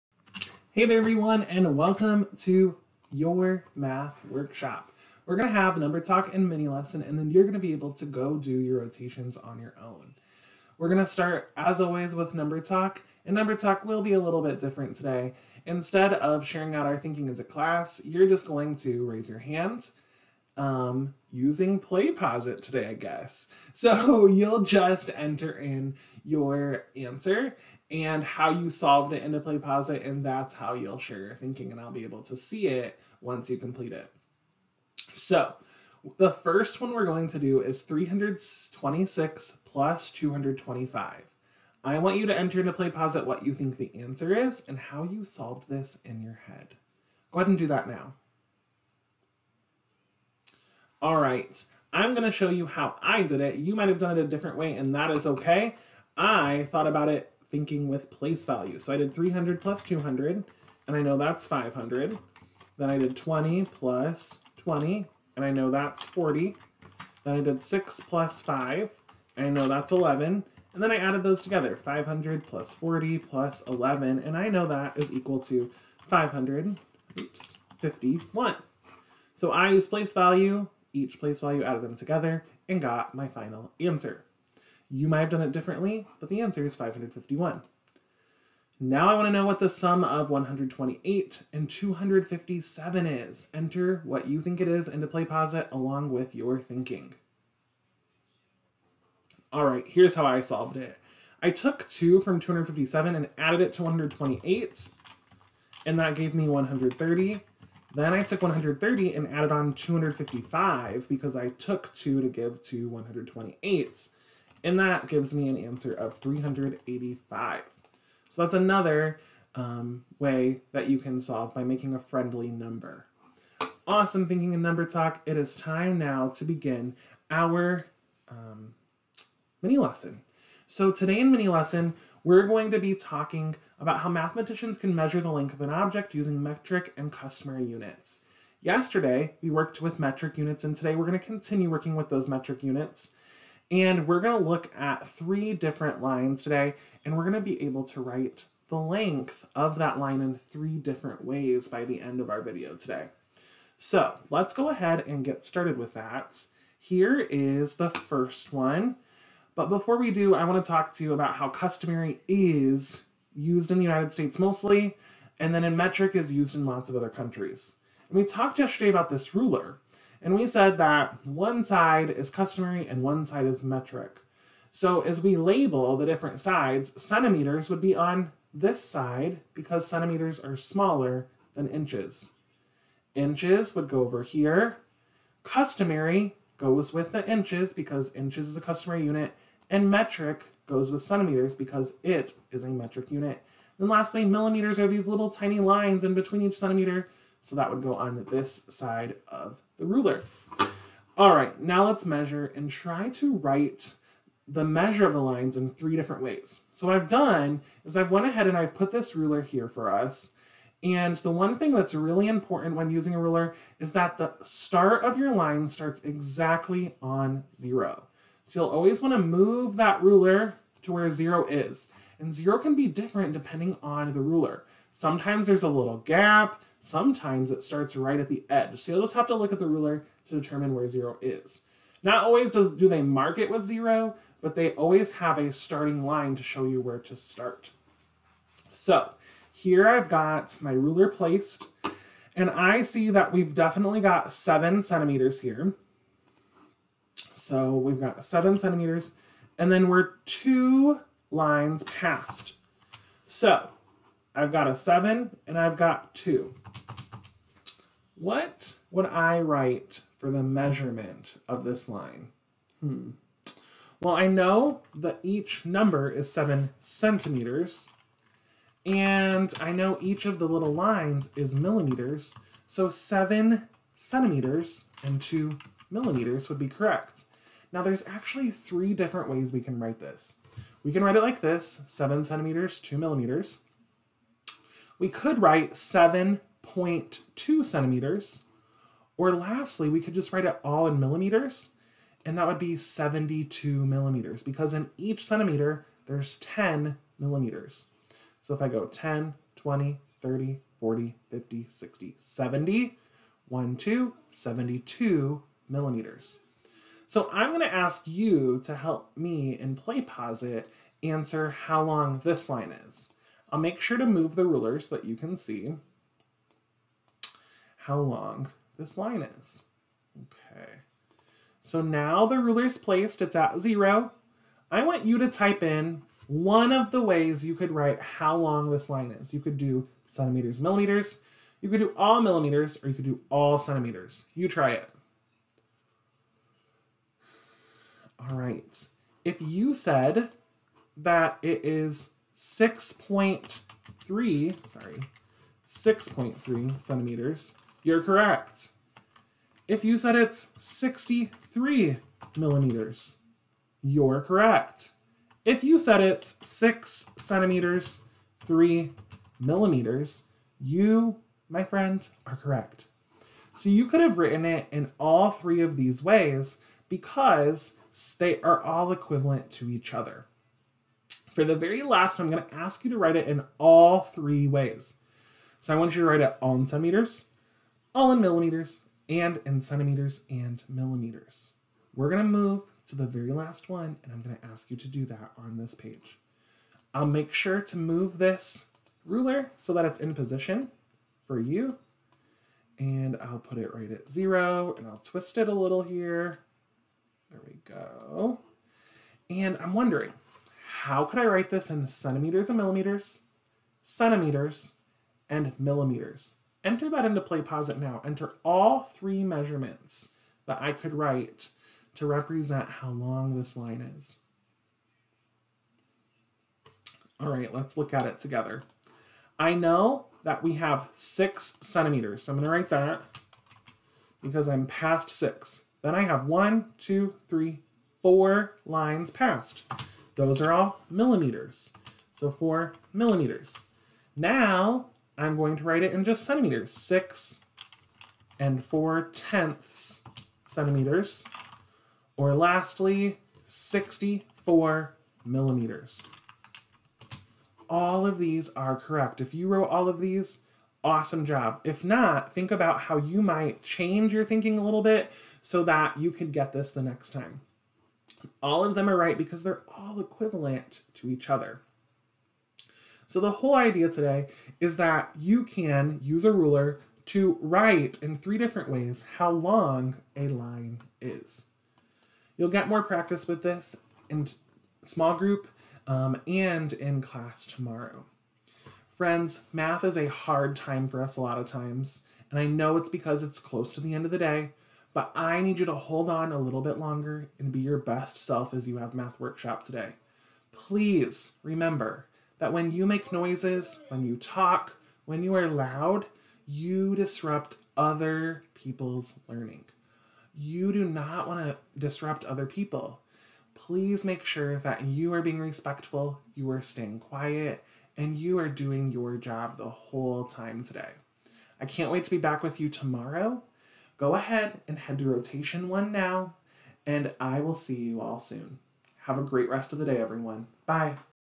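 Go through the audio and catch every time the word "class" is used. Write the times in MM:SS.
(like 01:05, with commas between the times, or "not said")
00:17, 07:57.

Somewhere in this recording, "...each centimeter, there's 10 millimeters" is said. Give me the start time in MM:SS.
04:54.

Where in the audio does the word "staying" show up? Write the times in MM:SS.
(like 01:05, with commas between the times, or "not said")
08:26.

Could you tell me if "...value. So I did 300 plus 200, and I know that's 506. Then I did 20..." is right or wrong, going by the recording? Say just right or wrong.
wrong.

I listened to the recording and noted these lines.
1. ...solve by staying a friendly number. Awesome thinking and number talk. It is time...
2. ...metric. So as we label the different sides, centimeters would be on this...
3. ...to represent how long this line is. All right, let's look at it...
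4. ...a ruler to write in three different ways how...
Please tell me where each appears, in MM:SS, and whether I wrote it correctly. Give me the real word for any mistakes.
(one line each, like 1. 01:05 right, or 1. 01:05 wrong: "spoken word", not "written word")
1. 02:01 wrong: "making", not "staying"
2. 02:53 right
3. 06:51 right
4. 07:46 right.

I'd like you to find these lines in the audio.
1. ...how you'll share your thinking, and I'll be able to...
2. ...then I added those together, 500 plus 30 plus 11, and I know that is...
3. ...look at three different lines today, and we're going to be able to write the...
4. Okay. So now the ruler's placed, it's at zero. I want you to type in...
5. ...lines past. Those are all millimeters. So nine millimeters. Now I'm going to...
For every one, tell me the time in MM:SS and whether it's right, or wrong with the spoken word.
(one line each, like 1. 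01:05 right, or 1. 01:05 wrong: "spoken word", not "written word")
1. 00:30 right
2. 01:10 wrong: "40", not "30"
3. 02:24 right
4. 05:20 right
5. 07:08 wrong: "four", not "nine".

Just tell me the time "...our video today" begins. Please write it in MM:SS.
02:32.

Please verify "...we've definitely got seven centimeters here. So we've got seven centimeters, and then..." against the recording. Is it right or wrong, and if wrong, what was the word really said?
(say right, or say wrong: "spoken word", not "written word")
right.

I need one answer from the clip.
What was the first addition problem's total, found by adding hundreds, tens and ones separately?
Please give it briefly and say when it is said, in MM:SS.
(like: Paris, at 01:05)
551, at 01:26.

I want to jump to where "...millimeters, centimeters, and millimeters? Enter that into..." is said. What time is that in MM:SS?
06:42.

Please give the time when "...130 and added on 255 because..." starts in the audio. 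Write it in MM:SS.
01:48.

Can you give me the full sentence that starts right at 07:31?
If not, think about how you might change your thinking a little bit so that you could get this the next time.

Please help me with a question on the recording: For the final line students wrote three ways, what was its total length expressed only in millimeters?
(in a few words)
64.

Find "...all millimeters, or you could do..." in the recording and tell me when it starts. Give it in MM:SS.
05:31.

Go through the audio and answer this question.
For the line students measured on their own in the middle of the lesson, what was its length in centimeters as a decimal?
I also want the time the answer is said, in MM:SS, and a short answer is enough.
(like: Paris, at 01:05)
6.3 centimeters, at 05:45.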